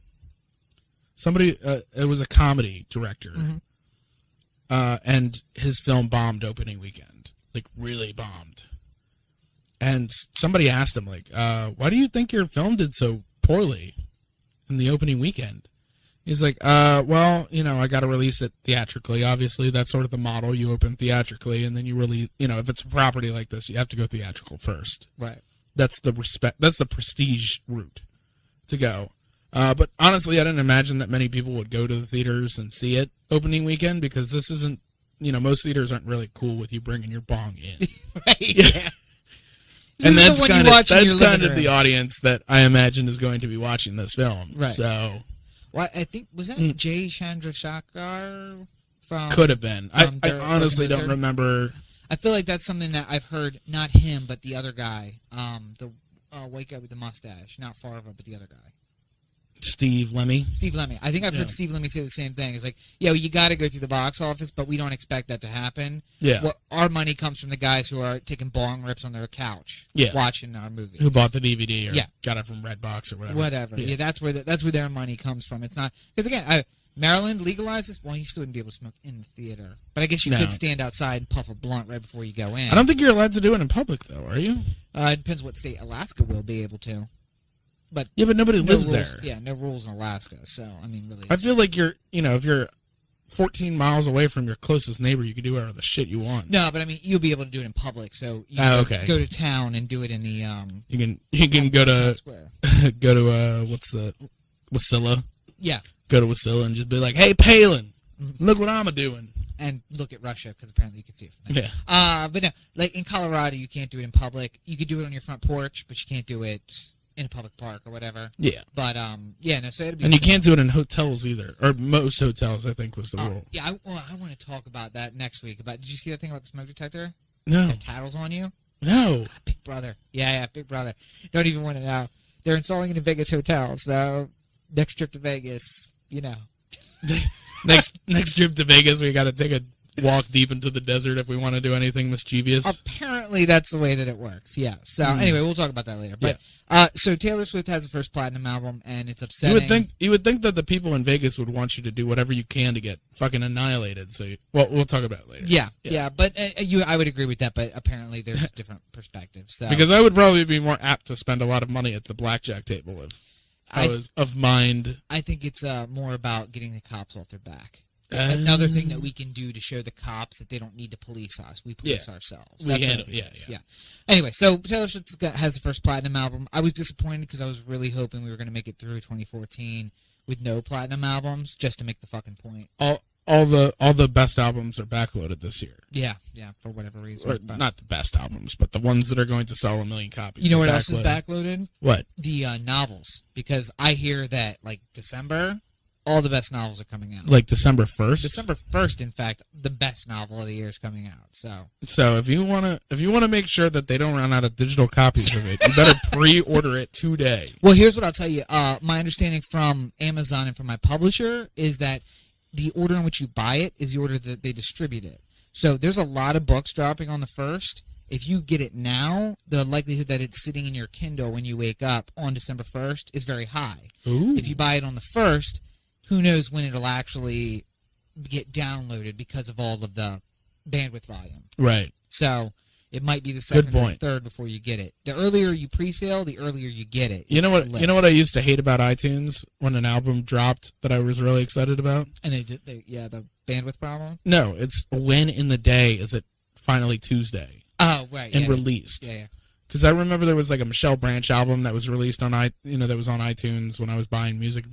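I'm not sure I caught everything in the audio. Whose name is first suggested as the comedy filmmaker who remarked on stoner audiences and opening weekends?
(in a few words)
Jay Chandrasekhar.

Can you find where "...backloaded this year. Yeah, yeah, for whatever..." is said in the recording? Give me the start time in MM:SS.
03:04.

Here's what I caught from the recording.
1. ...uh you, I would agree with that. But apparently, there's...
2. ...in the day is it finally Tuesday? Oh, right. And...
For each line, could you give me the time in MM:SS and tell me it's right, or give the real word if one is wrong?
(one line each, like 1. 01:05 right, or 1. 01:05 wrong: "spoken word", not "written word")
1. 02:36 right
2. 04:05 right.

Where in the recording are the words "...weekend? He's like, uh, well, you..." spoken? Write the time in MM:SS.
00:15.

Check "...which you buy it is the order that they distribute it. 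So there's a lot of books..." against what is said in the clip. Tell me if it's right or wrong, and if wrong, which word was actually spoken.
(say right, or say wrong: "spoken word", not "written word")
right.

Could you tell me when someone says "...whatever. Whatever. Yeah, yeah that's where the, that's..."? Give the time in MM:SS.
01:13.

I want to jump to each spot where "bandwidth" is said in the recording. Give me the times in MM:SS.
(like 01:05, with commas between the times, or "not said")
03:50, 04:03.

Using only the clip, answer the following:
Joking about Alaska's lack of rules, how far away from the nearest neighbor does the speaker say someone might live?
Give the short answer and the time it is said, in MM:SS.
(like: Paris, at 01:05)
14 miles, at 01:33.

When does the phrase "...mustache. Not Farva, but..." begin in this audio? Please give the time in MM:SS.
00:56.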